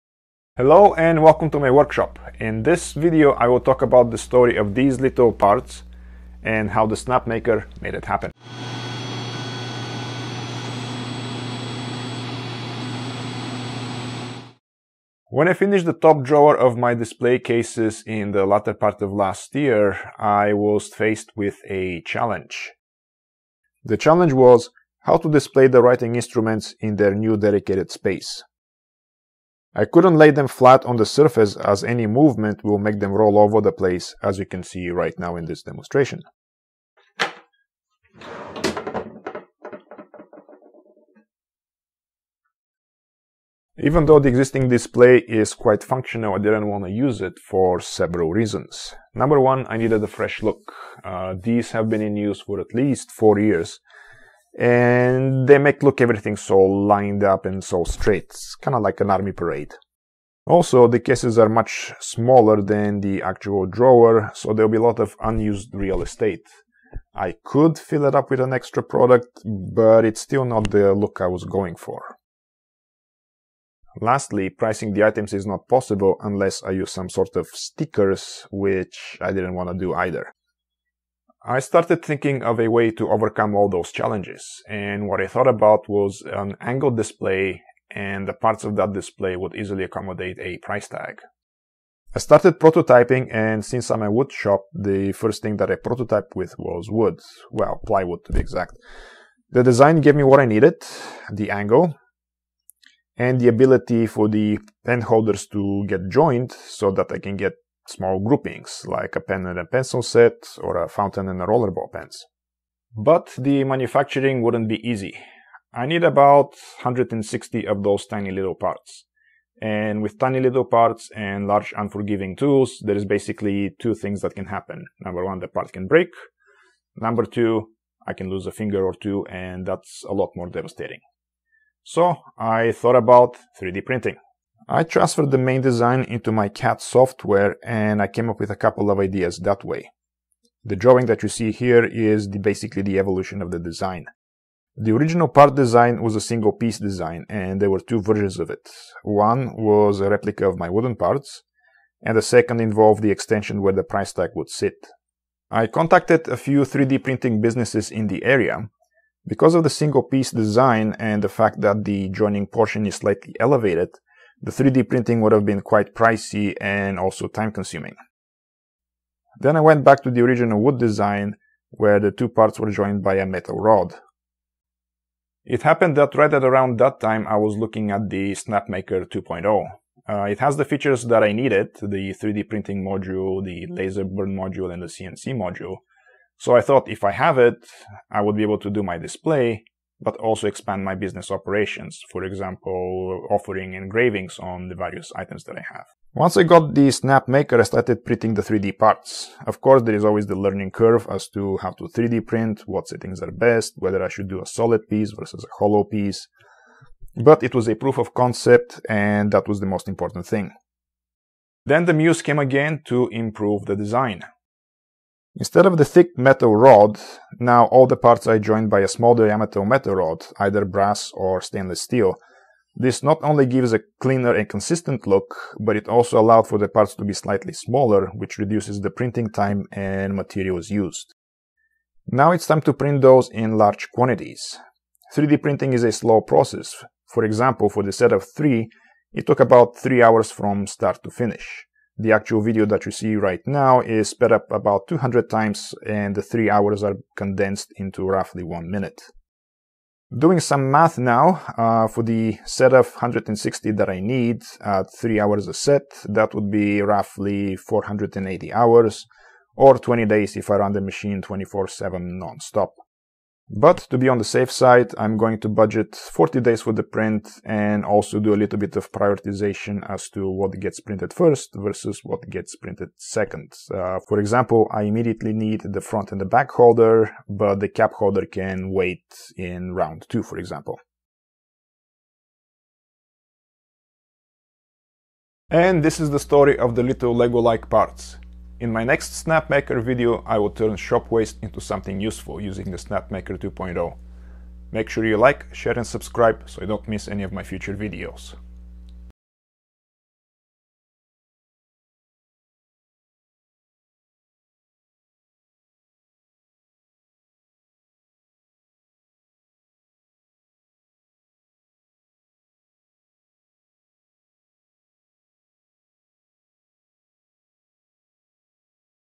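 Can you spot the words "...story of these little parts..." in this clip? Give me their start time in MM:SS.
00:04.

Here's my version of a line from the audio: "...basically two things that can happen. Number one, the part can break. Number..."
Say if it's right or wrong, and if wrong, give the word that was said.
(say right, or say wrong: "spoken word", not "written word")
right.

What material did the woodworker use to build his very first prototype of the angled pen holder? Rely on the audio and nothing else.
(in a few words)
Plywood.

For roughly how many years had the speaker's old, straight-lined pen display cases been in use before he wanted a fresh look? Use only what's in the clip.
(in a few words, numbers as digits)
4.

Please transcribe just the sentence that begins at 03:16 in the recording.
Once I got the Snapmaker, I started printing the 3D parts.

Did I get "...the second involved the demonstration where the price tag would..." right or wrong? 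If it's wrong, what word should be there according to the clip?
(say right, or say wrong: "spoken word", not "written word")
wrong: "extension", not "demonstration".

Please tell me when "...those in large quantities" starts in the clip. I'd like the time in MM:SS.
03:53.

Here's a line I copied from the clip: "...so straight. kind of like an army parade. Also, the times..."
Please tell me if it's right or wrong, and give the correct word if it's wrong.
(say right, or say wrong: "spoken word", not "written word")
wrong: "cases", not "times".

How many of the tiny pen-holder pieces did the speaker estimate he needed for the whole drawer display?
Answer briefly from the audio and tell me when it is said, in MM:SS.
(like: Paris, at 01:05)
160, at 01:56.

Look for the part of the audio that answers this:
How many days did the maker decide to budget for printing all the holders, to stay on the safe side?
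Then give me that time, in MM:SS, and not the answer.
04:25.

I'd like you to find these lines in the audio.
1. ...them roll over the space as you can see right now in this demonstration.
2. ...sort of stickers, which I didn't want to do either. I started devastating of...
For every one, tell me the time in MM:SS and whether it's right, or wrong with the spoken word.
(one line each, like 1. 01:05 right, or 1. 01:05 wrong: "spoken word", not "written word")
1. 00:32 wrong: "place", not "space"
2. 01:17 wrong: "thinking", not "devastating".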